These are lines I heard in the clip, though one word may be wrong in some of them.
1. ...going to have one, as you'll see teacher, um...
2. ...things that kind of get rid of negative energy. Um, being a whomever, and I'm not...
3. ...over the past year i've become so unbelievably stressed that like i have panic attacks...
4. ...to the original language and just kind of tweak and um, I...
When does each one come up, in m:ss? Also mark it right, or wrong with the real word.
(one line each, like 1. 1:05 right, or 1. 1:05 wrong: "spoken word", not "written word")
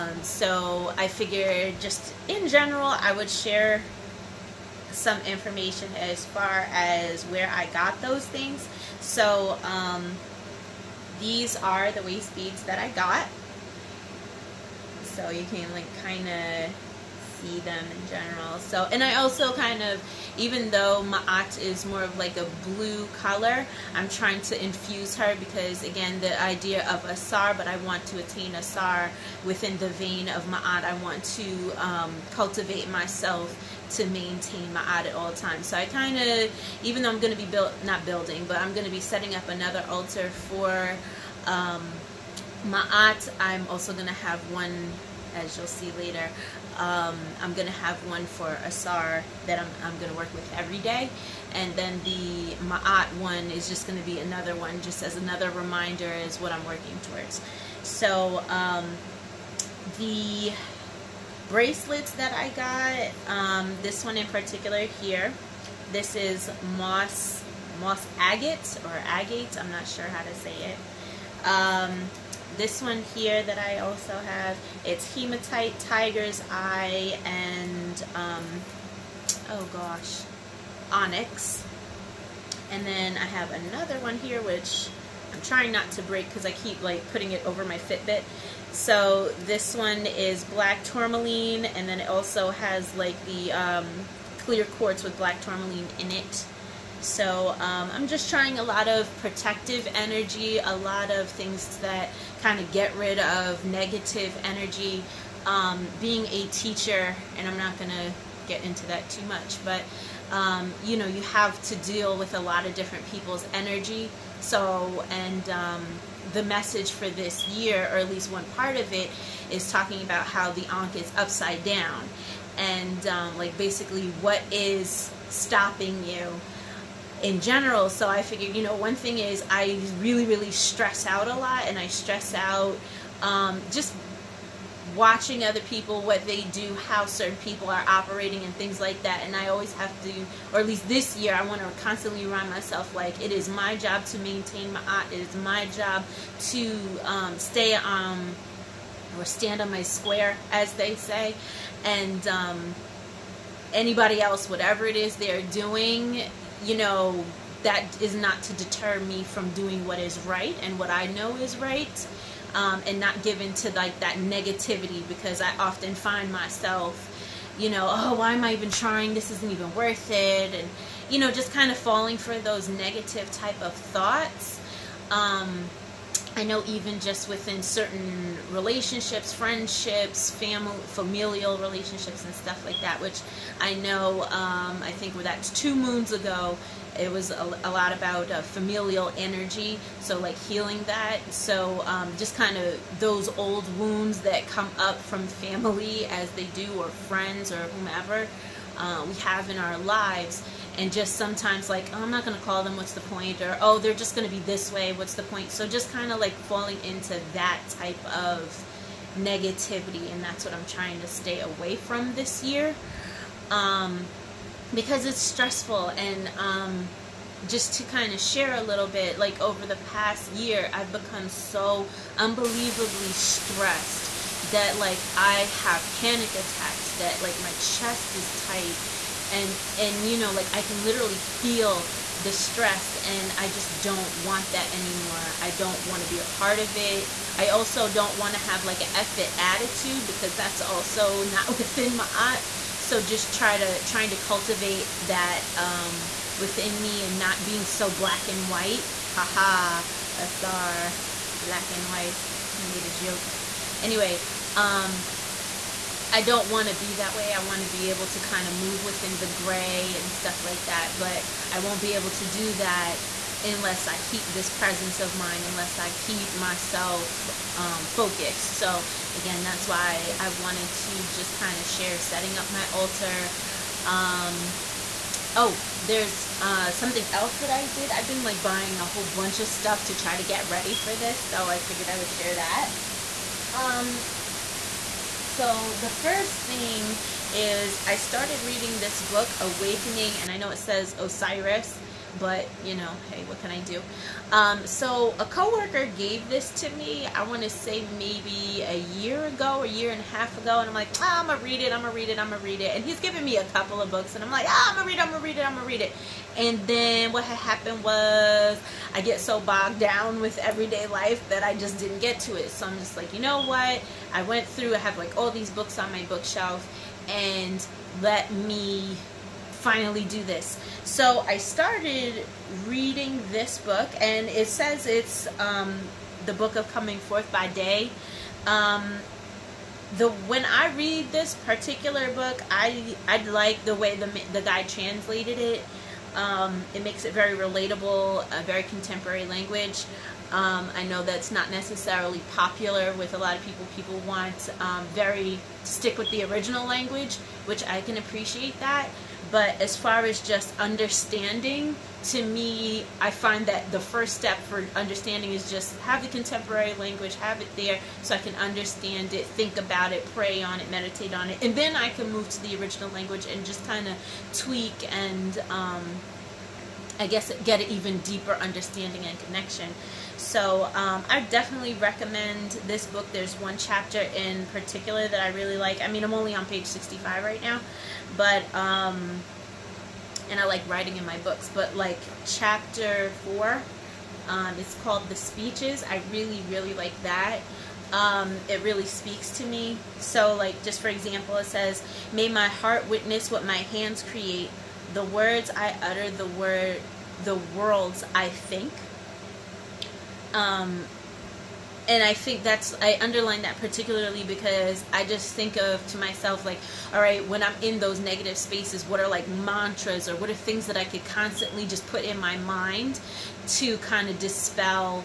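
1. 0:43 wrong: "later", not "teacher"
2. 1:41 wrong: "teacher", not "whomever"
3. 3:39 right
4. 6:02 right.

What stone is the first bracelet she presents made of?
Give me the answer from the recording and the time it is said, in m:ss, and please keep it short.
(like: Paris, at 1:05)
Moss agate, at 1:07.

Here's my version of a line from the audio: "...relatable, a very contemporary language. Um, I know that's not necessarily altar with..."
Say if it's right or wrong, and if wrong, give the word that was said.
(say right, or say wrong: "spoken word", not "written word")
wrong: "popular", not "altar".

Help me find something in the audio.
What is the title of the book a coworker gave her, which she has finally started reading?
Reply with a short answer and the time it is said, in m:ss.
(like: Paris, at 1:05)
Awakening, at 4:49.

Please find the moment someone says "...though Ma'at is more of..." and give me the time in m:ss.
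0:20.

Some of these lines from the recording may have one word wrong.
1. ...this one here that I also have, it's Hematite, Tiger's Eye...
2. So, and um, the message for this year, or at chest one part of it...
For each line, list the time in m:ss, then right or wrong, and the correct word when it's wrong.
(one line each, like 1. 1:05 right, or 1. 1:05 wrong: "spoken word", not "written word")
1. 1:12 right
2. 1:54 wrong: "least", not "chest".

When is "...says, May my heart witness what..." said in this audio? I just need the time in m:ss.
6:31.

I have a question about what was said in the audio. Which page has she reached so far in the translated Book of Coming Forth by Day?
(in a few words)
65.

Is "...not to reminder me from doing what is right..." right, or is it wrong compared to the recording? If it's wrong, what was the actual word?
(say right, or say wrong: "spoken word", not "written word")
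wrong: "deter", not "reminder".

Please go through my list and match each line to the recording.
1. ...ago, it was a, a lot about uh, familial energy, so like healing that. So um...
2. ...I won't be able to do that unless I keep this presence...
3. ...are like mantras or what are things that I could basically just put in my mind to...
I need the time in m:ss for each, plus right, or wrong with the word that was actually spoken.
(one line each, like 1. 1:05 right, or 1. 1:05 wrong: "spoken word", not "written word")
1. 3:06 right
2. 4:21 right
3. 6:49 wrong: "constantly", not "basically".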